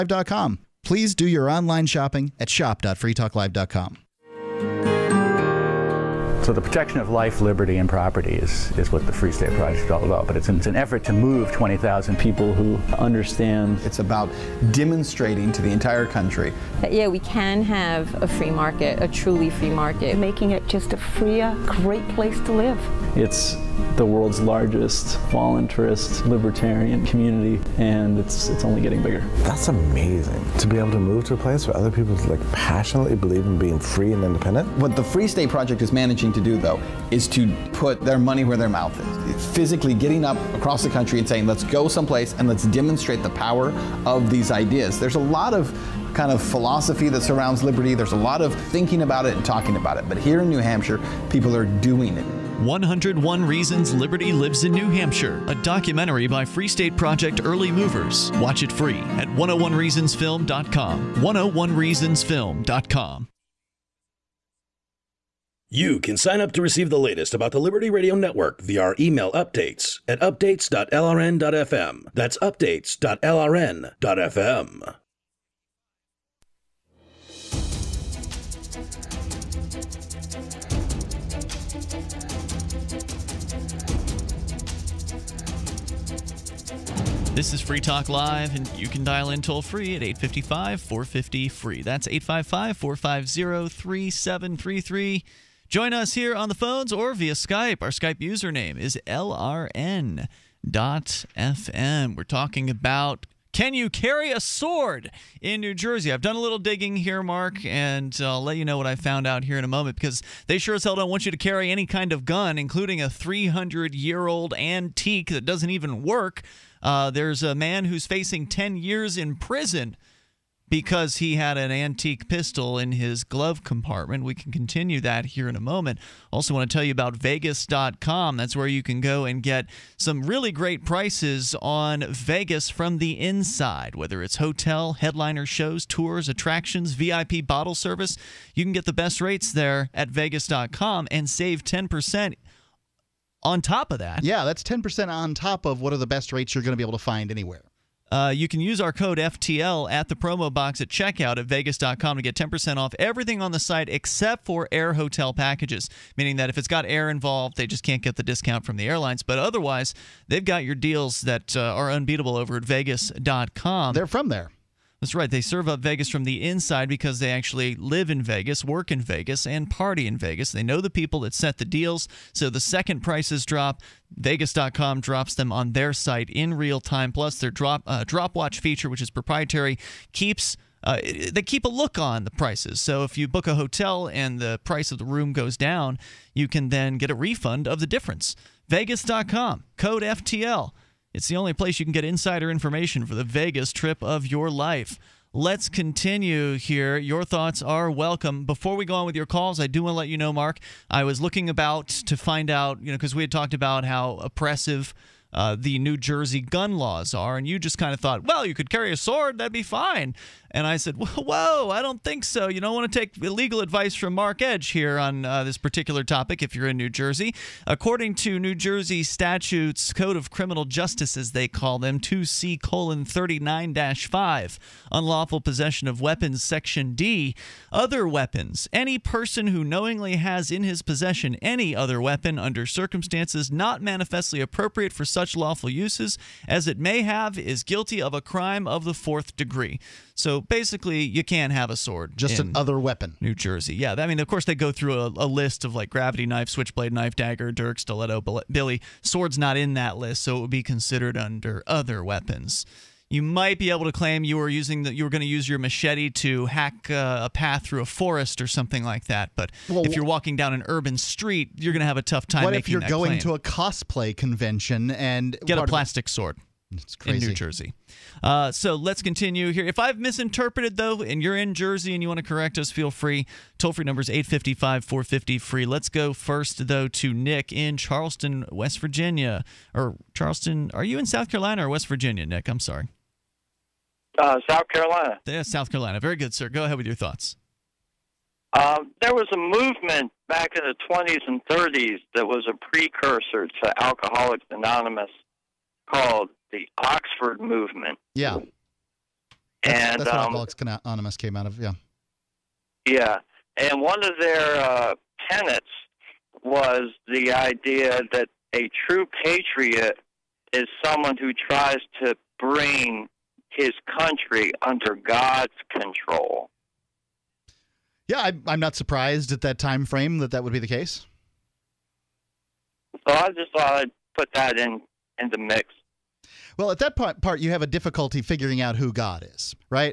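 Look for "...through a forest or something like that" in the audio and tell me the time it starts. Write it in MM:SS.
04:17.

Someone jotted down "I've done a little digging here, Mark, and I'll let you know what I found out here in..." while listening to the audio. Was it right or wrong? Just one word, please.
right.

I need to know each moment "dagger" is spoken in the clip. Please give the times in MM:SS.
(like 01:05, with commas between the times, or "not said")
04:07.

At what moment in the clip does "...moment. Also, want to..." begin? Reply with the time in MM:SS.
02:05.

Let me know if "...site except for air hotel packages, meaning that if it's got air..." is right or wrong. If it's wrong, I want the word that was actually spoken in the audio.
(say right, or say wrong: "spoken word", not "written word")
right.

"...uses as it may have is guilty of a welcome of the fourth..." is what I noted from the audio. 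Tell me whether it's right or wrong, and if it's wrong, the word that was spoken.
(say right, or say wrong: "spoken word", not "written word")
wrong: "crime", not "welcome".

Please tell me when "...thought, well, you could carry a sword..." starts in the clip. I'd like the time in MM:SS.
03:27.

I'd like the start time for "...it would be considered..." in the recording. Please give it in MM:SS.
04:10.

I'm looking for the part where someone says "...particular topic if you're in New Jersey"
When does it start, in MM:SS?
03:35.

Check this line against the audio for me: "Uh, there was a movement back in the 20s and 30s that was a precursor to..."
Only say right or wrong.
right.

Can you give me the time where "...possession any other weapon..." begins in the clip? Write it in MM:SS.
03:50.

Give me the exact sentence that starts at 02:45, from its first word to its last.
They serve up Vegas from the inside because they actually live in Vegas, work in Vegas, and party in Vegas.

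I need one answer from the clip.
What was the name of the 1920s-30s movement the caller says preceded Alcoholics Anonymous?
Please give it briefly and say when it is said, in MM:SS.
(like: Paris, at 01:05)
Oxford Movement, at 04:56.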